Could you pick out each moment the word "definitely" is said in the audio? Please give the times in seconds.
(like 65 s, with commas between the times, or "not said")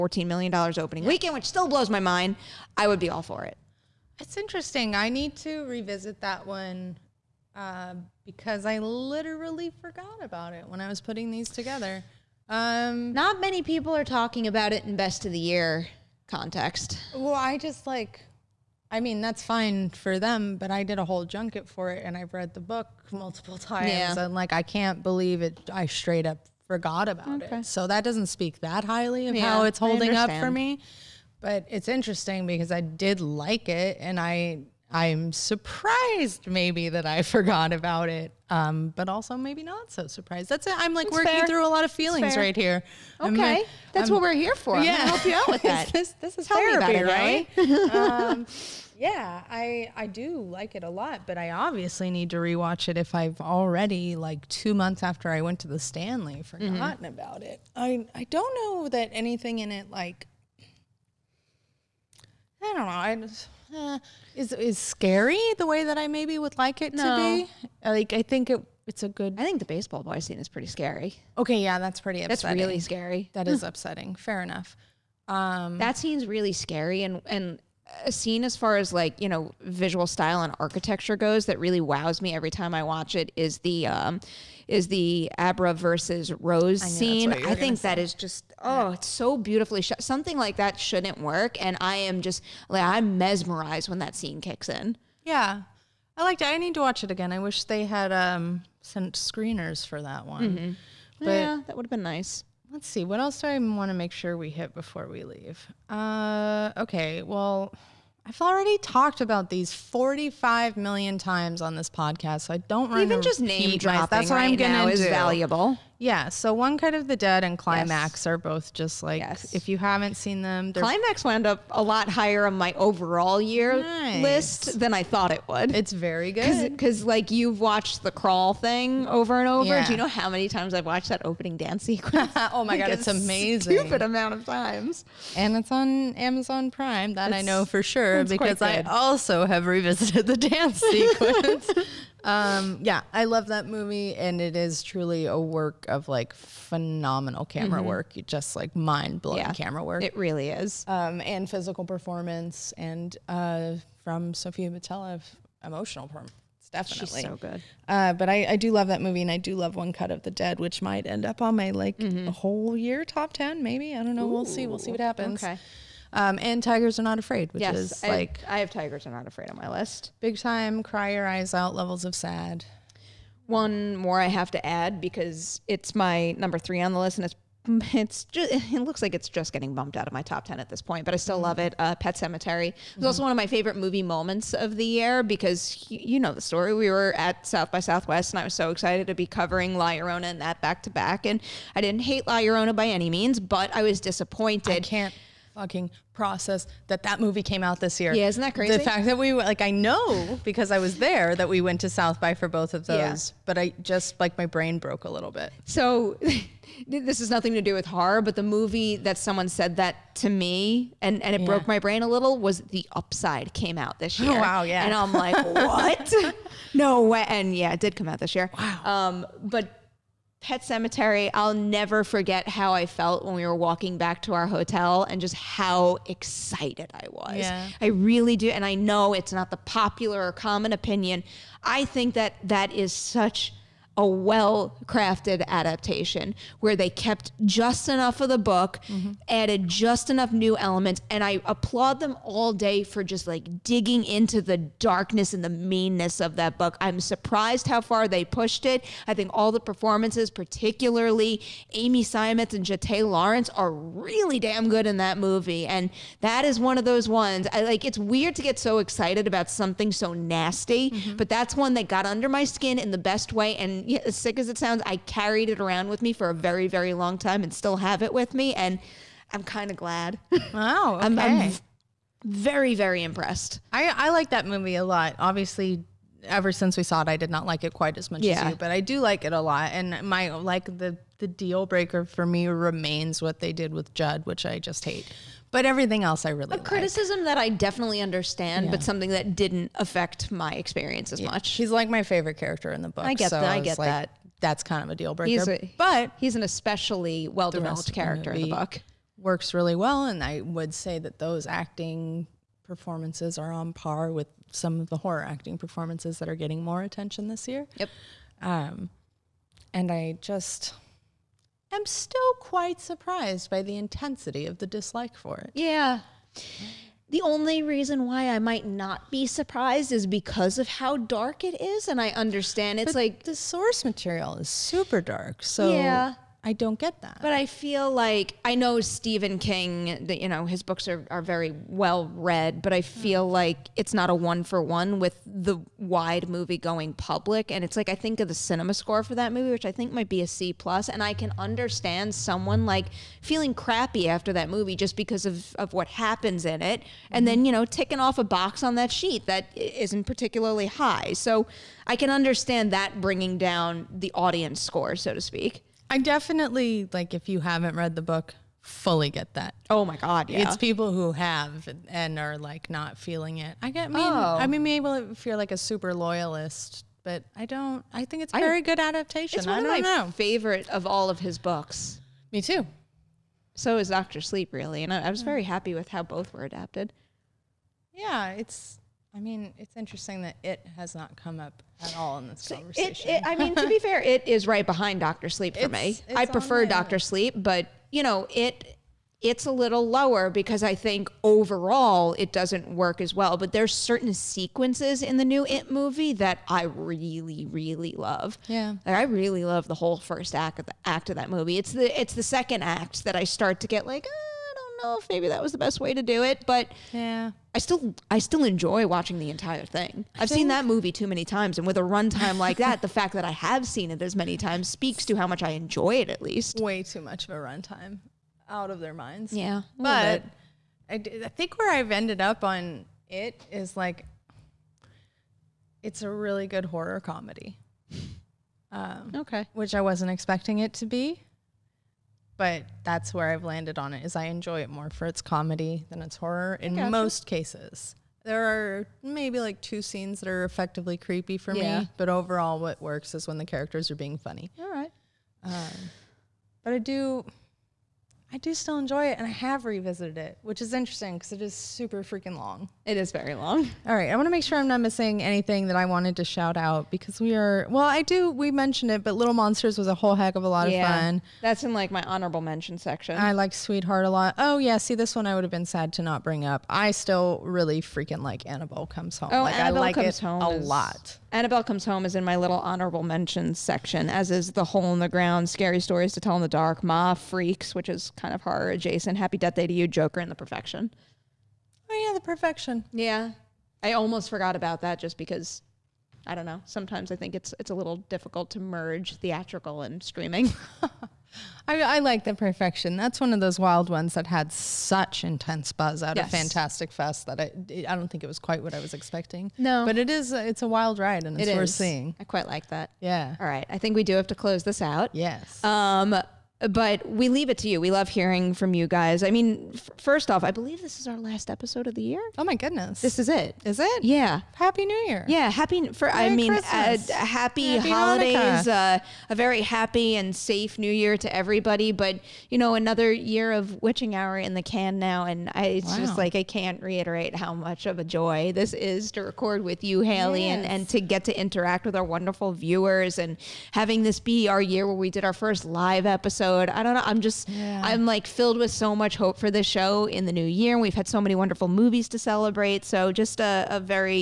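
156 s, 287 s, 355 s.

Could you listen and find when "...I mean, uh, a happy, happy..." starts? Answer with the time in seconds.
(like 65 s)
516 s.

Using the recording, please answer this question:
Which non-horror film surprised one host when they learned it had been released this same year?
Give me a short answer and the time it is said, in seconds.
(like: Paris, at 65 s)
The Upside, at 212 s.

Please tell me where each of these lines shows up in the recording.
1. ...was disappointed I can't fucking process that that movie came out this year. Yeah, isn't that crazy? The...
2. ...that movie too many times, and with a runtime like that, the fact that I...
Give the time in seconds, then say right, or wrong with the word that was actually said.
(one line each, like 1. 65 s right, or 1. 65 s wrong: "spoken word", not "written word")
1. 193 s right
2. 410 s right.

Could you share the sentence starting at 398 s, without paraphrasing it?
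Yeah, like I really love the whole first act of the act of that movie.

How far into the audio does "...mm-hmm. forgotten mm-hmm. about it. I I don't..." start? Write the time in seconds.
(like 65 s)
56 s.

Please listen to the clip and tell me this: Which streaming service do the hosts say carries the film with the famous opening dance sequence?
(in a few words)
Amazon Prime.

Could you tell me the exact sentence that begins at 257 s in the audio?
I like it's weird to get so excited about something so nasty, mm-hmm.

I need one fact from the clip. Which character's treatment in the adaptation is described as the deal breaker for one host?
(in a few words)
Judd.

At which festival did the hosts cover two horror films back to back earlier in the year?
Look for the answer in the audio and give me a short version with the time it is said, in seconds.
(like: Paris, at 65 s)
South by Southwest, at 187 s.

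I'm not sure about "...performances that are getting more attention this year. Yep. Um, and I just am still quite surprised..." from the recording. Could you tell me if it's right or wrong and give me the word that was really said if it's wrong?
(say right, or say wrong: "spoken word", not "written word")
right.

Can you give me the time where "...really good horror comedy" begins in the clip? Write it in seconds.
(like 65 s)
426 s.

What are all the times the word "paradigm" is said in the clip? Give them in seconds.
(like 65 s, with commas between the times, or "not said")
not said.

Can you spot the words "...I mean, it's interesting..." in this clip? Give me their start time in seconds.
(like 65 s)
379 s.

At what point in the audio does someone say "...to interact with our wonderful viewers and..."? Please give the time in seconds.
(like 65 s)
531 s.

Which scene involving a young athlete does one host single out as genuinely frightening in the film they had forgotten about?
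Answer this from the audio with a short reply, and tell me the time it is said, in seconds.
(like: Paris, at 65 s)
baseball boy scene, at 69 s.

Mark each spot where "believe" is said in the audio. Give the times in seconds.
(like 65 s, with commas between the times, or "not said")
25 s, 510 s.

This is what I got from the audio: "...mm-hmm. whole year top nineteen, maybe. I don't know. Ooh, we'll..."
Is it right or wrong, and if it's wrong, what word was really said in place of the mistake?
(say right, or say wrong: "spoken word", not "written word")
wrong: "ten", not "nineteen".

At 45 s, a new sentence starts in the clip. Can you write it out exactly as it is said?
this, this, is Tell therapy, it, right?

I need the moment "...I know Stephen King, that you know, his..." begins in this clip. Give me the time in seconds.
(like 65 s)
328 s.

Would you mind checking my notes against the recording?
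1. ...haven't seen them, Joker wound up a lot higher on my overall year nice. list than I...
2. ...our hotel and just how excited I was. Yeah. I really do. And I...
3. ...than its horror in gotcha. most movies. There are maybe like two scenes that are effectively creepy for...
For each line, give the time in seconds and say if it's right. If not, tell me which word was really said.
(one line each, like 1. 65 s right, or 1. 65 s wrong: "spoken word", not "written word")
1. 119 s wrong: "Climax", not "Joker"
2. 224 s right
3. 435 s wrong: "cases", not "movies".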